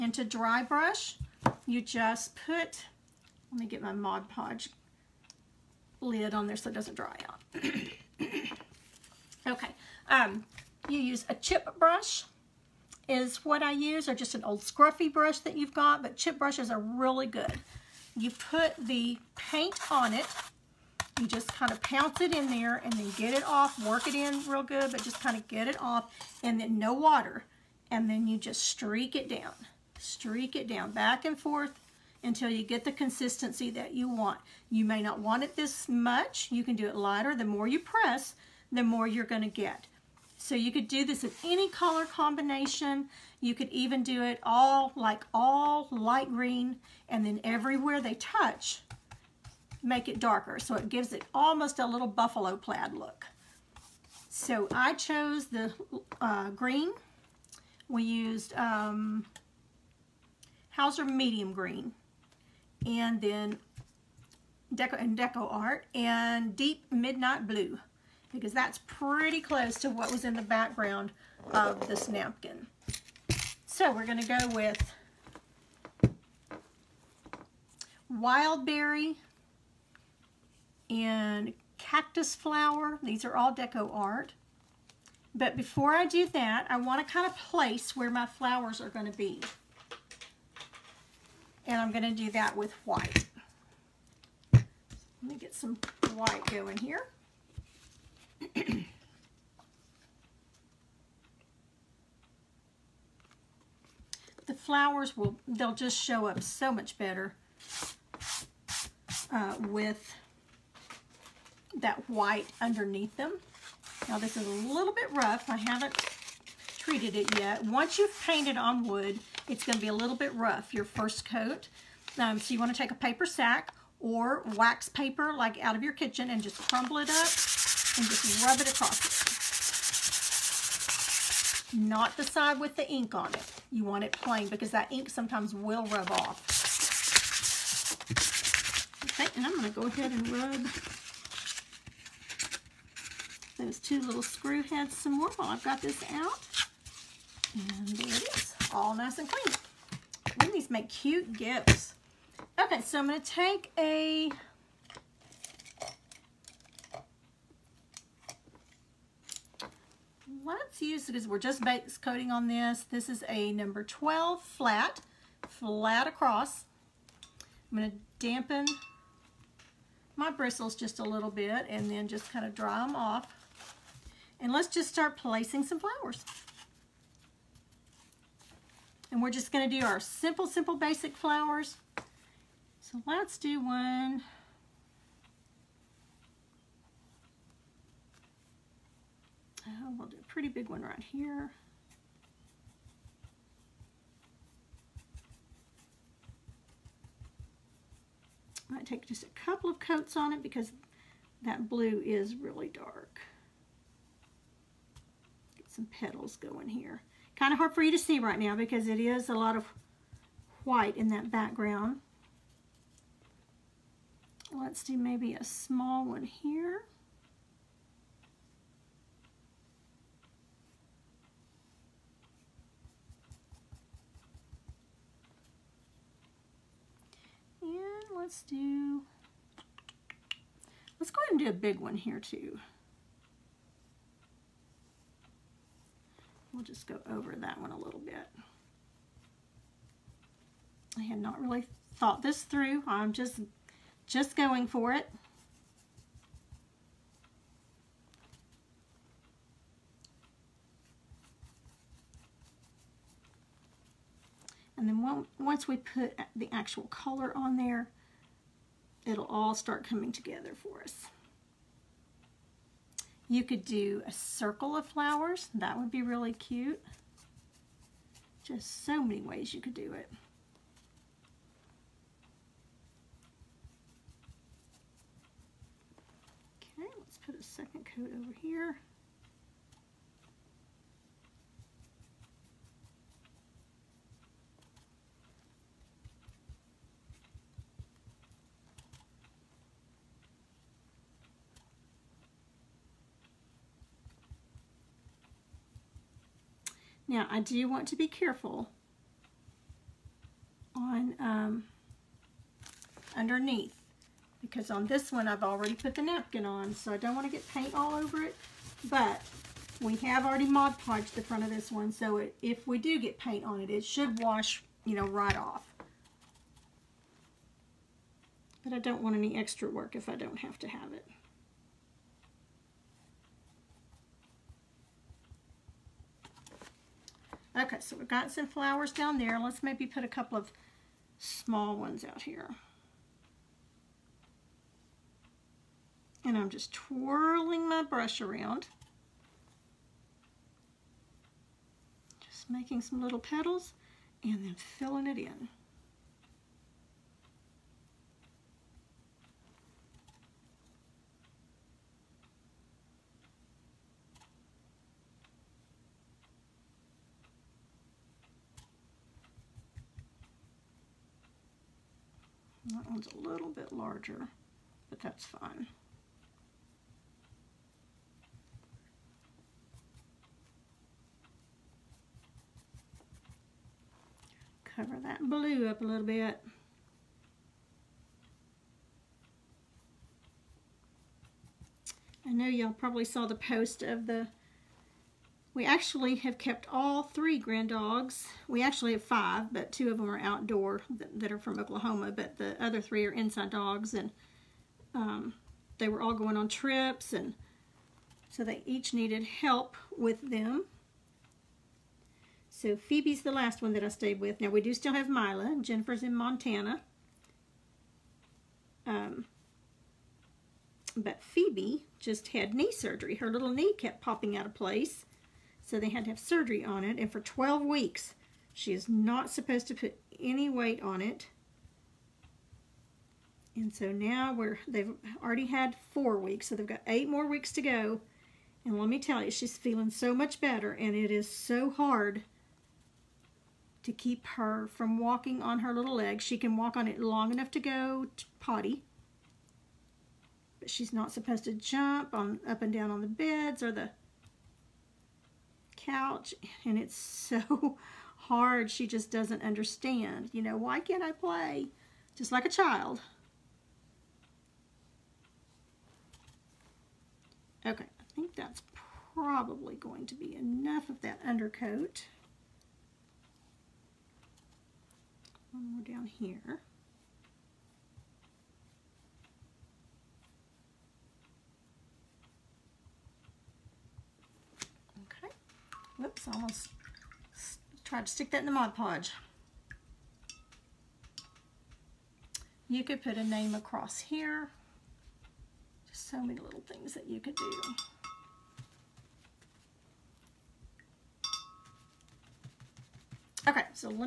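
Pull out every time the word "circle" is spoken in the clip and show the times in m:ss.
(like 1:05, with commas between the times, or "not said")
4:24.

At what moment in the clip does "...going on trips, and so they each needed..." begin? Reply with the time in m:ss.
6:36.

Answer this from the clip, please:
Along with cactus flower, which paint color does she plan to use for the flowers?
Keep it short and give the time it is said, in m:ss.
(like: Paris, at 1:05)
wild berry, at 1:18.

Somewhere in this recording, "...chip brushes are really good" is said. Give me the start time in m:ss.
0:16.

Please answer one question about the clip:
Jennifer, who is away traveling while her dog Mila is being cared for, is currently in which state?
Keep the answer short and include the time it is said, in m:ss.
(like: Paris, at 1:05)
Montana, at 6:46.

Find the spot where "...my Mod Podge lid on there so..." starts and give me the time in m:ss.
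0:03.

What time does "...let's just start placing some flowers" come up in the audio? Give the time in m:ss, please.
2:54.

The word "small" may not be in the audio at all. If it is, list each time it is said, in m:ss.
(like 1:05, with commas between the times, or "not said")
3:35, 5:31.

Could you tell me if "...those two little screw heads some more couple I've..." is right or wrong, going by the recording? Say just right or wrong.
wrong.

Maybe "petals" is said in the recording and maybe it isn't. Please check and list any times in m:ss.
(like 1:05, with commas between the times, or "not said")
3:25, 5:43.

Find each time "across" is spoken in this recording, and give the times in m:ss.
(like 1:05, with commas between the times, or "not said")
2:08, 2:46, 8:03.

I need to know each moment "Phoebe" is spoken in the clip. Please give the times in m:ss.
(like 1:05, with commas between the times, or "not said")
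6:42, 6:51.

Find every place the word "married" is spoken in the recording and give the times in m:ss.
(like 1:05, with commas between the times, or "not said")
not said.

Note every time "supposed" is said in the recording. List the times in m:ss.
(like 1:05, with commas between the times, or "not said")
6:59, 7:21.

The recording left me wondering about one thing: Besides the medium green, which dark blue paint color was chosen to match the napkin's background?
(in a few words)
Deep Midnight Blue.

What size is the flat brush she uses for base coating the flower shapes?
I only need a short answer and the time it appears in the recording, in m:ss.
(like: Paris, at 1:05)
12, at 2:43.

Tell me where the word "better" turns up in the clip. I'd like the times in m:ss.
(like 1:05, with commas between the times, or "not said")
1:46, 7:10.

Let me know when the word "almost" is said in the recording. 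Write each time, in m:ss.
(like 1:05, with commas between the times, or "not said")
0:51, 7:56.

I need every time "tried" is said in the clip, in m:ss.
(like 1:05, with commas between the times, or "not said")
7:57.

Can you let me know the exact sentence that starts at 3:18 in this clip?
Might take just a couple of coats on it because that blue is really dark.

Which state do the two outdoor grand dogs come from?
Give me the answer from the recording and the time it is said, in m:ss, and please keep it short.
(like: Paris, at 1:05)
Oklahoma, at 6:31.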